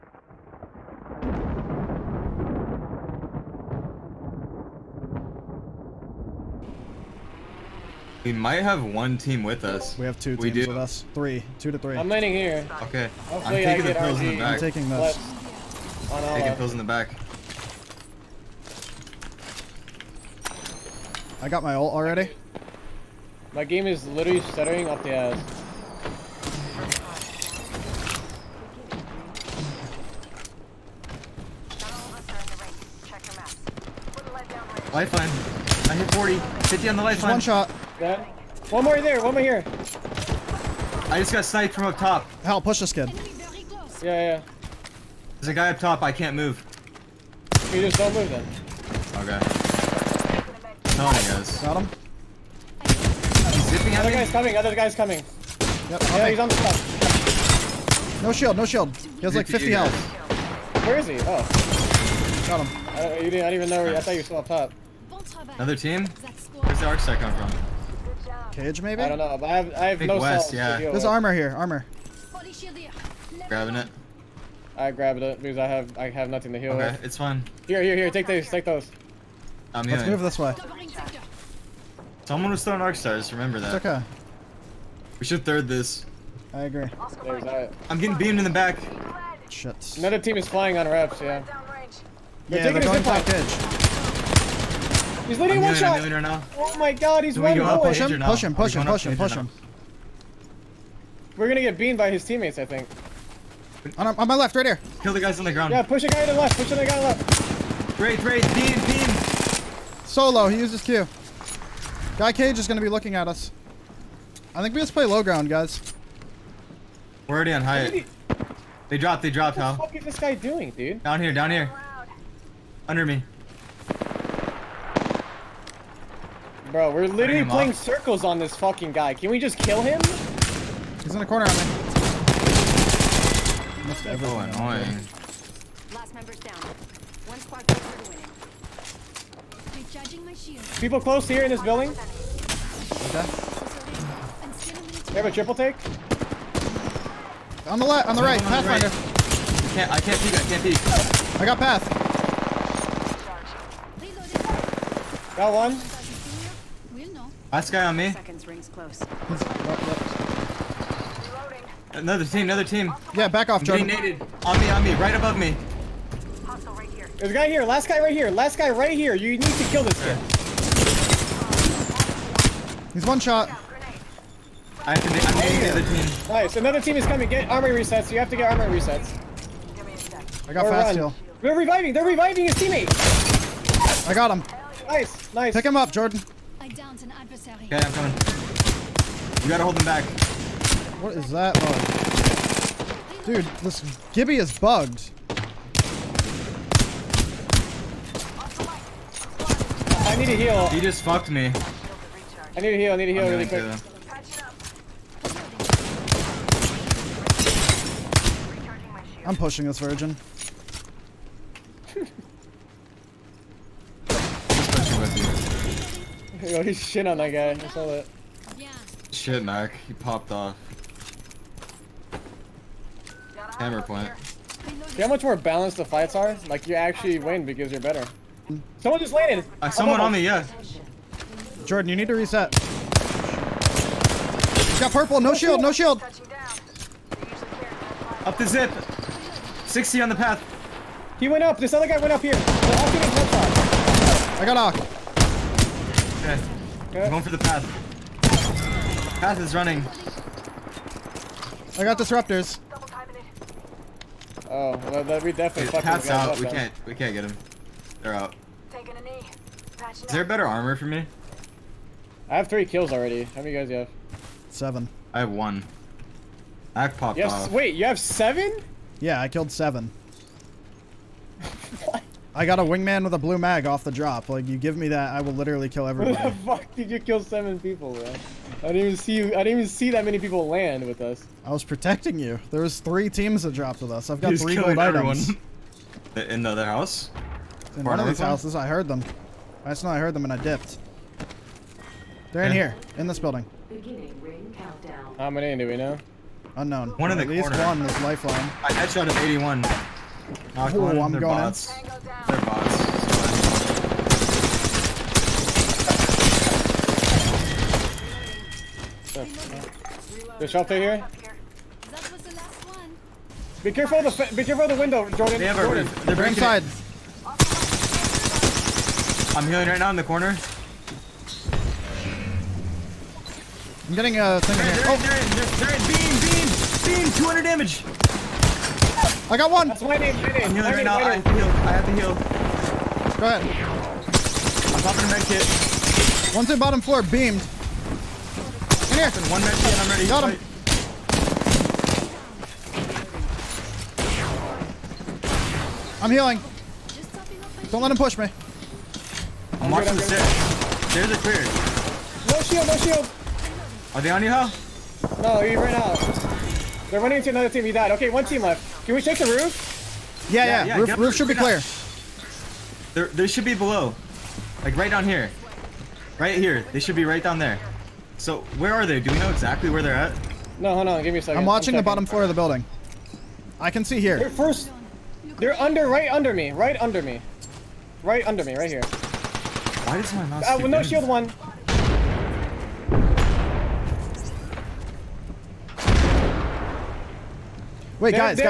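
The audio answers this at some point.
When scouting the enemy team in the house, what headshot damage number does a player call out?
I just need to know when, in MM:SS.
04:59.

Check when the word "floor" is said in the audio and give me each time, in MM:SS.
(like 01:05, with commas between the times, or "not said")
05:36, 06:12.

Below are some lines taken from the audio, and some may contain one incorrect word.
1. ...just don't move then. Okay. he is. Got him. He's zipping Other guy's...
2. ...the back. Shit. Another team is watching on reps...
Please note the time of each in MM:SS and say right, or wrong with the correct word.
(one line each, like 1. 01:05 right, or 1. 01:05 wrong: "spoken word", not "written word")
1. 00:47 right
2. 01:28 wrong: "flying", not "watching".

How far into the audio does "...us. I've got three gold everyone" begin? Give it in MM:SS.
04:43.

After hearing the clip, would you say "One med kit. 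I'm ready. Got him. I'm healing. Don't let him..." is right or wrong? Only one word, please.
right.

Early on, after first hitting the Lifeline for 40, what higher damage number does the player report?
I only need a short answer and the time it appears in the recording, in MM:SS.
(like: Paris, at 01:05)
50, at 00:36.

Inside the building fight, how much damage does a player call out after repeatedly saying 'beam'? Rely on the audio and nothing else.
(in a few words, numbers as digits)
200.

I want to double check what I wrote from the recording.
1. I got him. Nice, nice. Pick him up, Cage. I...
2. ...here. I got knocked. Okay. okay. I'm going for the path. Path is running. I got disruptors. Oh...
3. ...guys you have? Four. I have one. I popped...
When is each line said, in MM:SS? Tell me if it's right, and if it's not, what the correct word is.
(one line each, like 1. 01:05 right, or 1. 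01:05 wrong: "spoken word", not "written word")
1. 03:04 wrong: "Jordan", not "Cage"
2. 04:02 right
3. 04:23 wrong: "Seven", not "Four".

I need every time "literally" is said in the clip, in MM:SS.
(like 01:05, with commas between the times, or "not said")
00:24, 02:07, 04:35.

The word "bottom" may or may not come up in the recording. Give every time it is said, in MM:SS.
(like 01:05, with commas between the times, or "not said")
05:36, 06:11.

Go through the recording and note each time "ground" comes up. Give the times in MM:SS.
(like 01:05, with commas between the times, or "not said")
01:45, 01:55.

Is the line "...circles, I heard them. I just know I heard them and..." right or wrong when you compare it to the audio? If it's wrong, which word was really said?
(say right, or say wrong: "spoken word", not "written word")
wrong: "houses", not "circles".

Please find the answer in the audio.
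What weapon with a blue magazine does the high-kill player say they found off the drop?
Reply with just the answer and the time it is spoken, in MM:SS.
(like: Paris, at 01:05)
Wingman, at 04:32.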